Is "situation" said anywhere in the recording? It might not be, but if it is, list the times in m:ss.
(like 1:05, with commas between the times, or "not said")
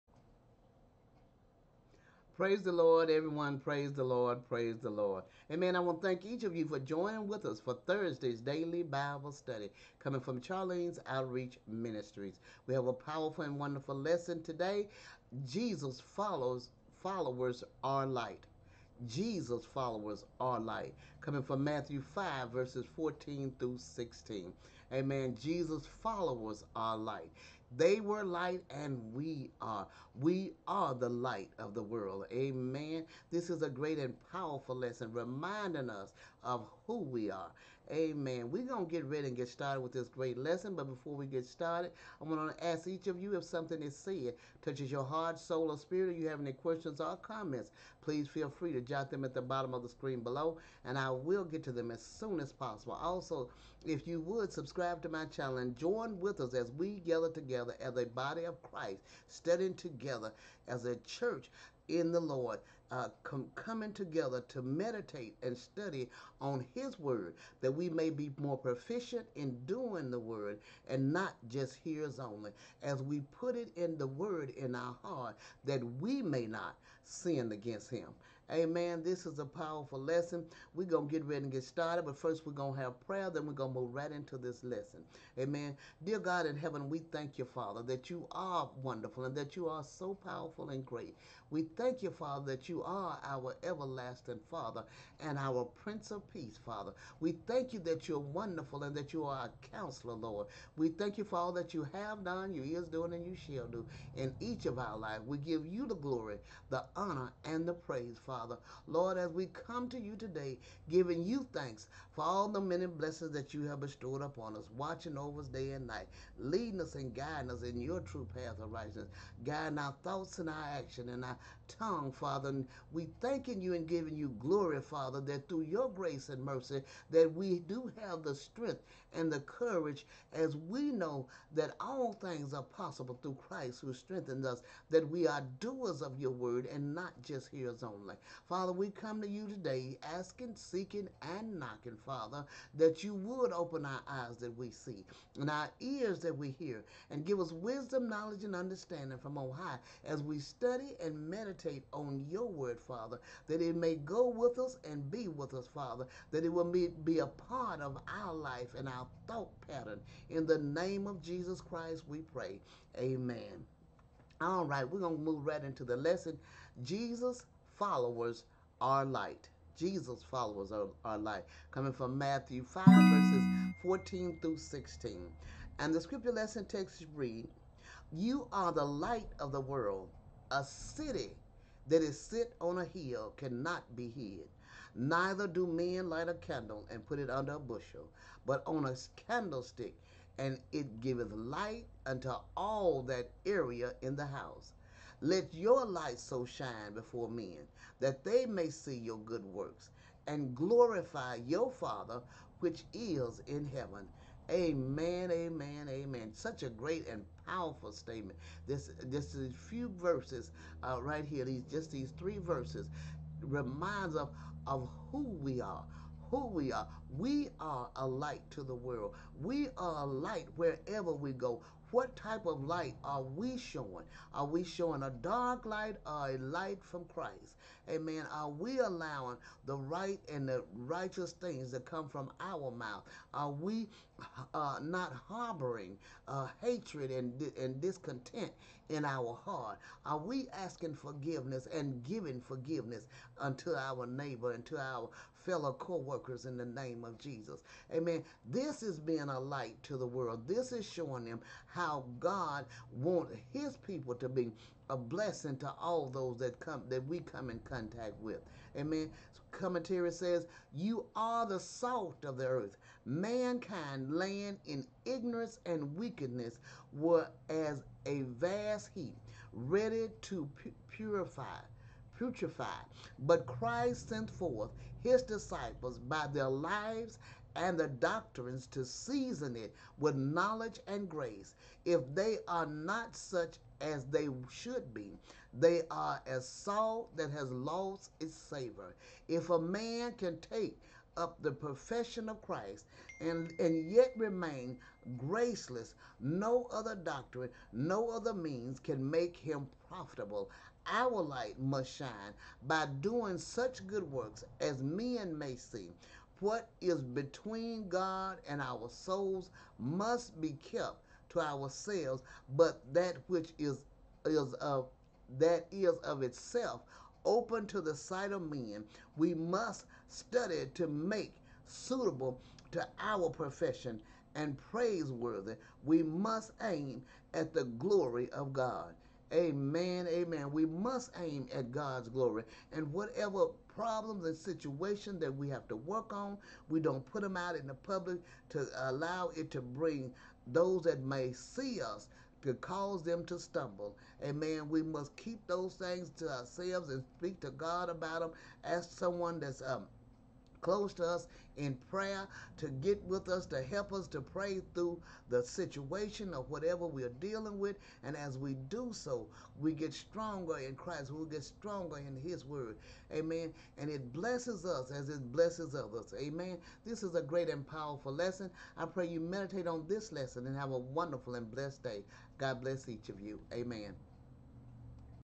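5:34, 5:55.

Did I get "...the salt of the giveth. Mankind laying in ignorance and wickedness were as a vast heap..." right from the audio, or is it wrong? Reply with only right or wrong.
wrong.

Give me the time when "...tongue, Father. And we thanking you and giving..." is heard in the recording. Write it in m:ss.
2:01.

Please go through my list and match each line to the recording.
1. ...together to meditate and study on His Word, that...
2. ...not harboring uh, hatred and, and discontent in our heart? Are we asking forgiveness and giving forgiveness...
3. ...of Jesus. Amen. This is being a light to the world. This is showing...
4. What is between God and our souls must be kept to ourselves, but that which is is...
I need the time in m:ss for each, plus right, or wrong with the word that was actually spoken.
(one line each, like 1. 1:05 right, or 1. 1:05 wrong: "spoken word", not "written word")
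1. 1:03 right
2. 3:54 right
3. 4:07 right
4. 5:06 right.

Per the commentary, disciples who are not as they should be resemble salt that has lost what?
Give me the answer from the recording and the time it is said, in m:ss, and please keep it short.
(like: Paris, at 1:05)
its savor, at 4:48.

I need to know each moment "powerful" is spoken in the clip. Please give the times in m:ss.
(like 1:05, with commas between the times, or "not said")
0:12, 0:34, 1:19, 1:30, 3:27, 6:07.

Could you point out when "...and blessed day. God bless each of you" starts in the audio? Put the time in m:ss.
6:11.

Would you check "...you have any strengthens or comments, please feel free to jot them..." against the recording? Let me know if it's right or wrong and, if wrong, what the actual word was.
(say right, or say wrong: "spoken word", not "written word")
wrong: "questions", not "strengthens".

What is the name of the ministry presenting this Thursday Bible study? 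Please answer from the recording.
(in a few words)
Charlene's Outreach Ministries.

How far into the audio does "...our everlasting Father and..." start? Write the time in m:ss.
1:33.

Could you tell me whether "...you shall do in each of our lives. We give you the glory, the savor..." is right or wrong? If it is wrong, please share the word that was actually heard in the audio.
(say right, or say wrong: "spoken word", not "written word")
wrong: "honor", not "savor".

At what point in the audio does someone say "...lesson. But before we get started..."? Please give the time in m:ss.
0:40.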